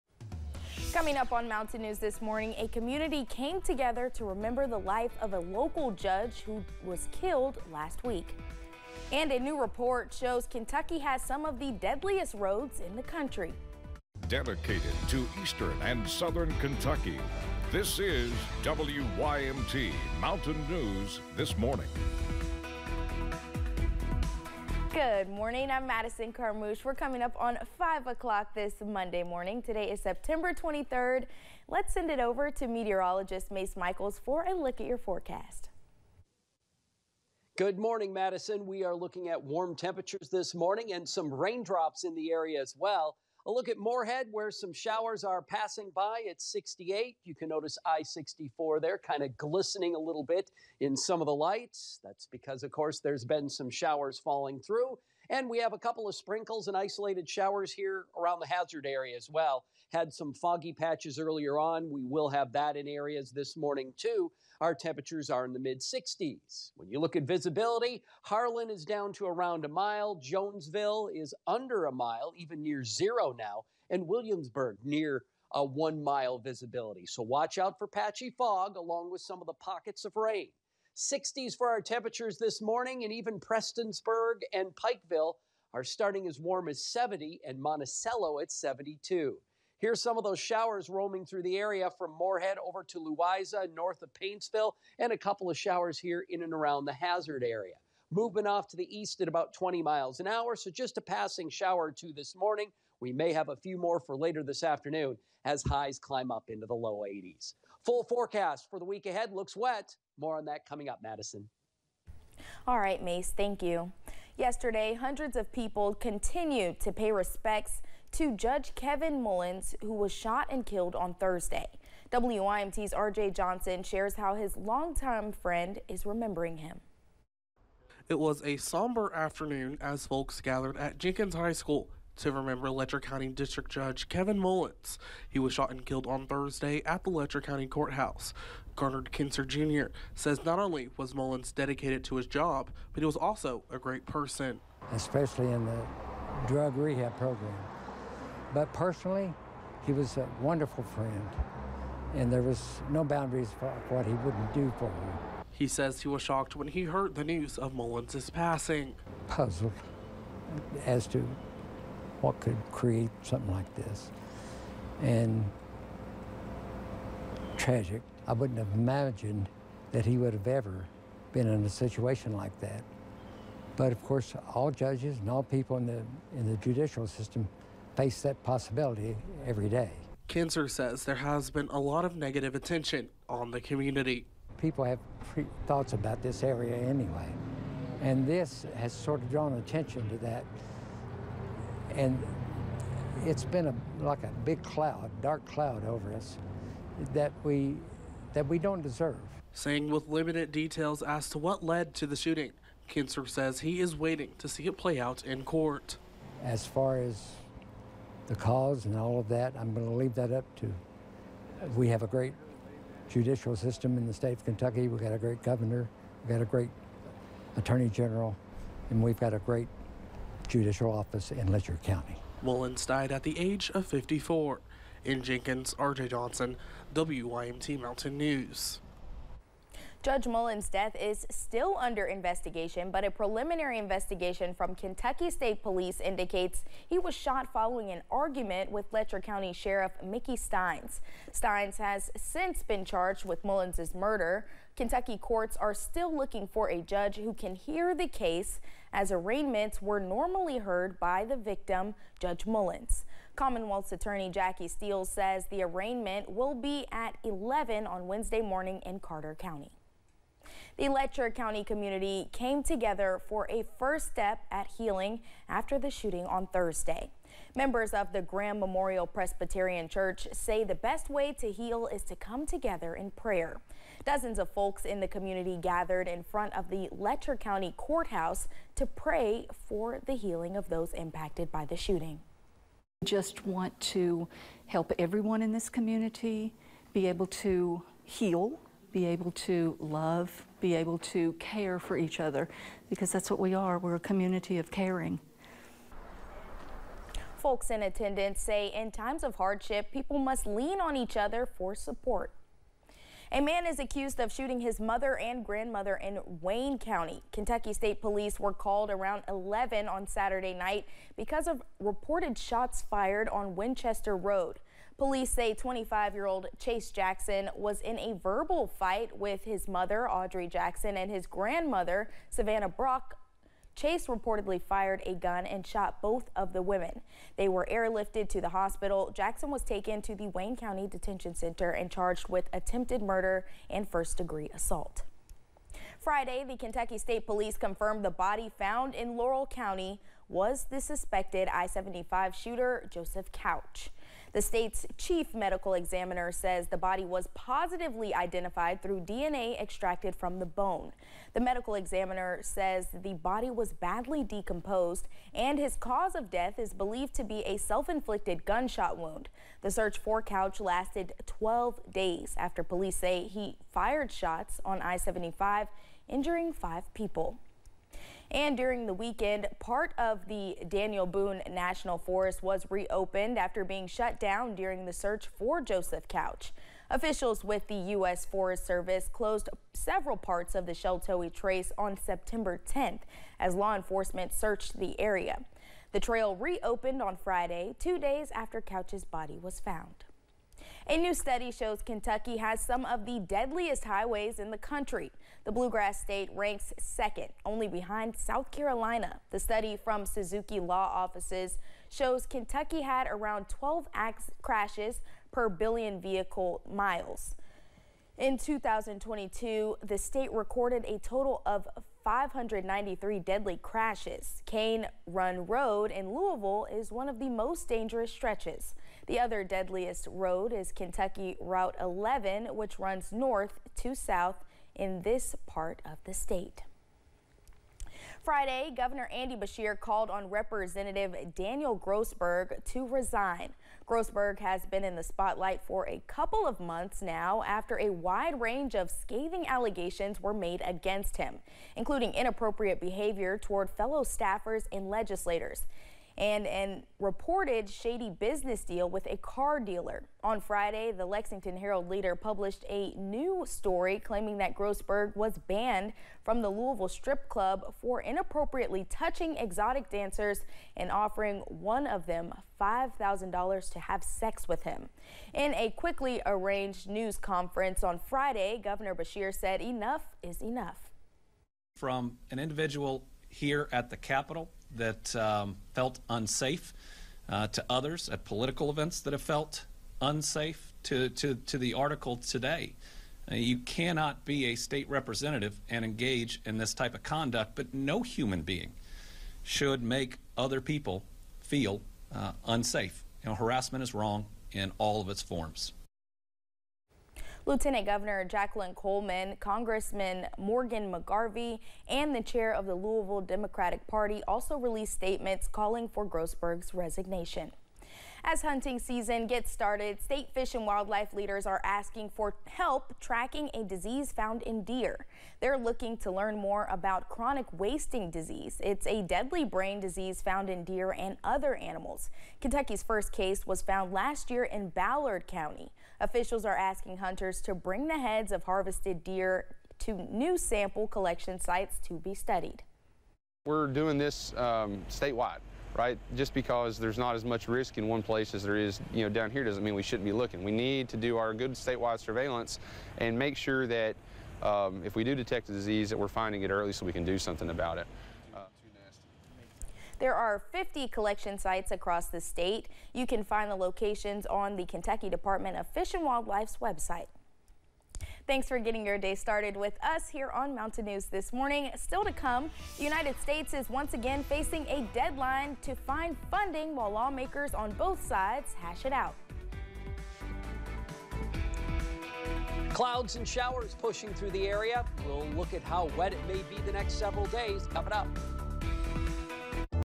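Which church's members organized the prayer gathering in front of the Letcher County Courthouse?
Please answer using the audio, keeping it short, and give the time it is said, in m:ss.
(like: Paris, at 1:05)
Graham Memorial Presbyterian Church, at 4:28.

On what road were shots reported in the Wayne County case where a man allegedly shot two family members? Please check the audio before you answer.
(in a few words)
Winchester Road.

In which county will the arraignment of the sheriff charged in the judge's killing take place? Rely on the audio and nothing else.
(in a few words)
Carter County.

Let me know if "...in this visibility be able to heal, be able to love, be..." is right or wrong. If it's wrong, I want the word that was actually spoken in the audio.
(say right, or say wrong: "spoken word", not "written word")
wrong: "community", not "visibility".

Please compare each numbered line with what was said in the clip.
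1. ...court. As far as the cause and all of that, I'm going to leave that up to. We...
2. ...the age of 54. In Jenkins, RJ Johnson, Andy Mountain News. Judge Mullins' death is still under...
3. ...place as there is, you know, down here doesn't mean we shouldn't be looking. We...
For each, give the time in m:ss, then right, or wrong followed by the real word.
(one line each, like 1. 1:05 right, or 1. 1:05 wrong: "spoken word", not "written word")
1. 3:25 right
2. 3:43 wrong: "WYMT", not "Andy"
3. 8:58 right.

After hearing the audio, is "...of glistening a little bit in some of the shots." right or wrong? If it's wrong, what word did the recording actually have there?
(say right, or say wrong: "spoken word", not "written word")
wrong: "lights", not "shots".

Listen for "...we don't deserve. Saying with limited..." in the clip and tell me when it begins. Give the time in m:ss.
3:18.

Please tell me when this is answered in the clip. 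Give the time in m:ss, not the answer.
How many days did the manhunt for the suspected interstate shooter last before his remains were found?
6:01.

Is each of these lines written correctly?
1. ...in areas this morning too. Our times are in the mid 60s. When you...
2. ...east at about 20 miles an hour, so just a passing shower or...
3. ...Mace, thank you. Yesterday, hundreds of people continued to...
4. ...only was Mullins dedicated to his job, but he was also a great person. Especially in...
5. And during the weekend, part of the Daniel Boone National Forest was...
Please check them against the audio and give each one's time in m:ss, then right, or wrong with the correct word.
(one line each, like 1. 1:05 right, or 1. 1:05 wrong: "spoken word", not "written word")
1. 1:02 wrong: "temperatures", not "times"
2. 1:38 right
3. 1:53 right
4. 2:20 right
5. 6:08 right.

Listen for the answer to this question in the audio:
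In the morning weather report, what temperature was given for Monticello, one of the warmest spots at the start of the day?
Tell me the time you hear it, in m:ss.
1:28.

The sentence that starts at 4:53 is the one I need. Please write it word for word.
We're a community of caring folks in attendance say in times of hardship, people must lean on each other for support.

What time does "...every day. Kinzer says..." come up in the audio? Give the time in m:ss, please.
2:59.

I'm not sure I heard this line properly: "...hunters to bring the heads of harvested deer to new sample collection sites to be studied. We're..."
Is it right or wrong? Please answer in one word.
right.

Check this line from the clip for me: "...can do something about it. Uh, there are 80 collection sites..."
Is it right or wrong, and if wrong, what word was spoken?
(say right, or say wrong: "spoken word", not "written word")
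wrong: "50", not "80".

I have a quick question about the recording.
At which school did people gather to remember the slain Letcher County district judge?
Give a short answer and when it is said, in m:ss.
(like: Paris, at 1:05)
Jenkins High School, at 2:10.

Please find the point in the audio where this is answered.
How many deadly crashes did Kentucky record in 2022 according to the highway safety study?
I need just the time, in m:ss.
6:52.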